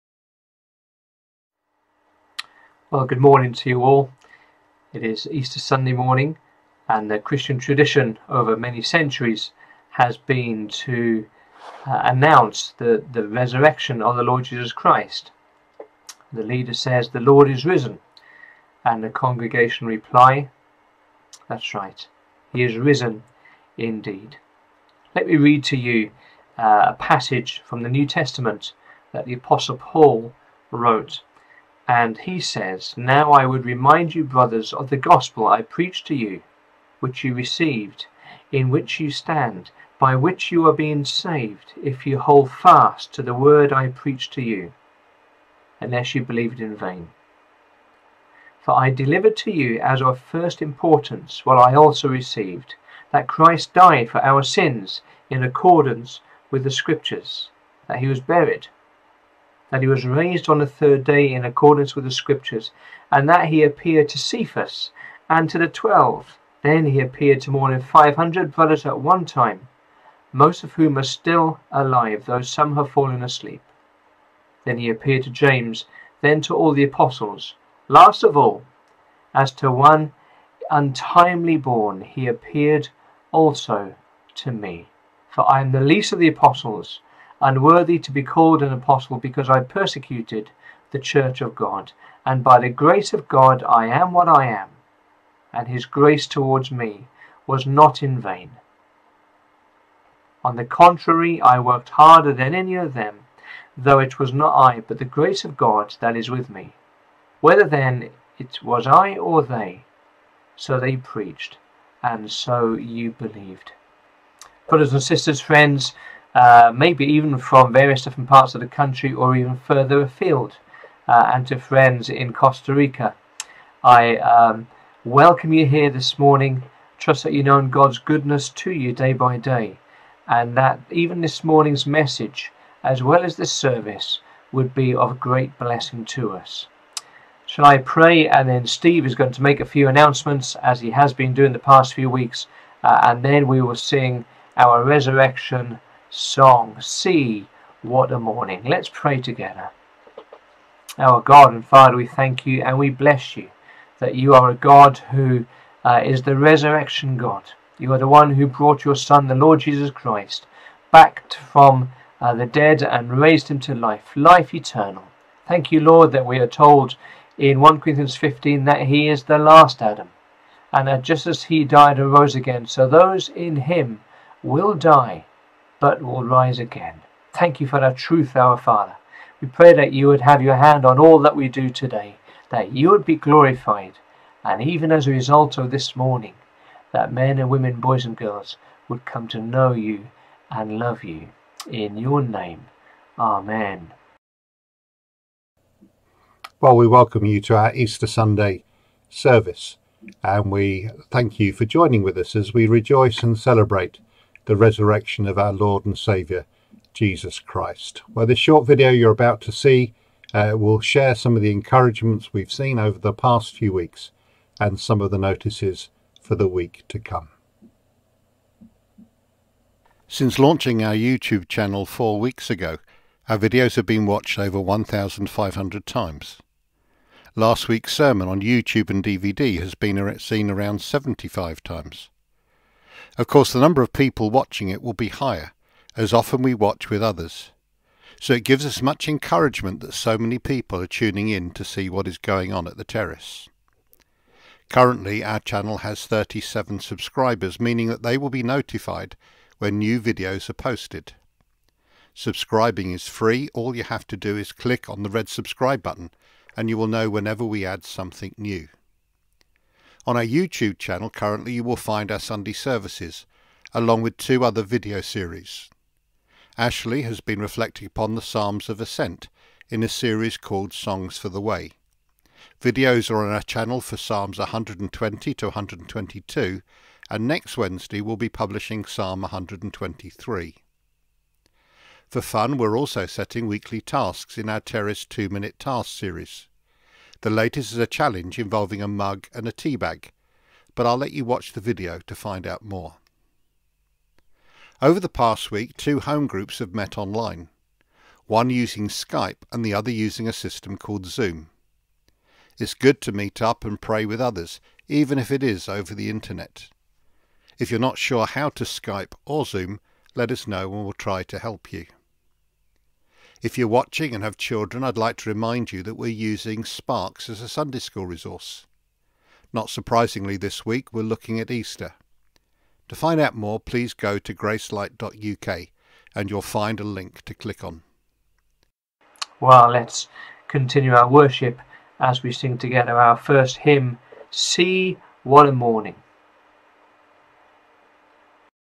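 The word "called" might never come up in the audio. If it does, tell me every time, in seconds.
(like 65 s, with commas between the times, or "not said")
88 s, 270 s, 300 s.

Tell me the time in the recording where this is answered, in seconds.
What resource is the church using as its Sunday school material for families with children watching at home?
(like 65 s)
316 s.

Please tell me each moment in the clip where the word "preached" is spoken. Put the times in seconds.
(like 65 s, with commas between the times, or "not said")
35 s, 43 s, 110 s.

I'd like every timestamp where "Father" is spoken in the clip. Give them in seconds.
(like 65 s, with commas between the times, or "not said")
151 s, 178 s.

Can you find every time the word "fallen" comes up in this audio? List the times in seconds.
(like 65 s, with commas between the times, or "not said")
72 s.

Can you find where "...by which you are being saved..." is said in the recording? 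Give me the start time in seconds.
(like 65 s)
39 s.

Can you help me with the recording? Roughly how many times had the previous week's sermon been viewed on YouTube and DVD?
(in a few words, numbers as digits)
75.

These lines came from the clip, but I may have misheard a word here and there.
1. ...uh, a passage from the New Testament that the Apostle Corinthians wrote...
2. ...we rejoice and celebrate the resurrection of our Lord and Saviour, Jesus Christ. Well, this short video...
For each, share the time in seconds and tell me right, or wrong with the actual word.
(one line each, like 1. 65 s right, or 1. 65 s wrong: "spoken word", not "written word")
1. 26 s wrong: "Paul", not "Corinthians"
2. 202 s right.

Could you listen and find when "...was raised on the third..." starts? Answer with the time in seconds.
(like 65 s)
59 s.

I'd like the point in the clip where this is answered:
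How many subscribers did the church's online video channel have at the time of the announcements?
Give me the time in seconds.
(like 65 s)
246 s.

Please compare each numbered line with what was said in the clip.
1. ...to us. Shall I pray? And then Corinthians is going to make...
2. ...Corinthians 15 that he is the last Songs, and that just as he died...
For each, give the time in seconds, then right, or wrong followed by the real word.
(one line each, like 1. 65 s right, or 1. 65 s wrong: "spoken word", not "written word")
1. 136 s wrong: "Steve", not "Corinthians"
2. 167 s wrong: "Adam", not "Songs".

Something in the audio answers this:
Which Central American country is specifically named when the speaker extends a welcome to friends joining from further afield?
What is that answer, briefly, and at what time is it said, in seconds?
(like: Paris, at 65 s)
Costa Rica, at 122 s.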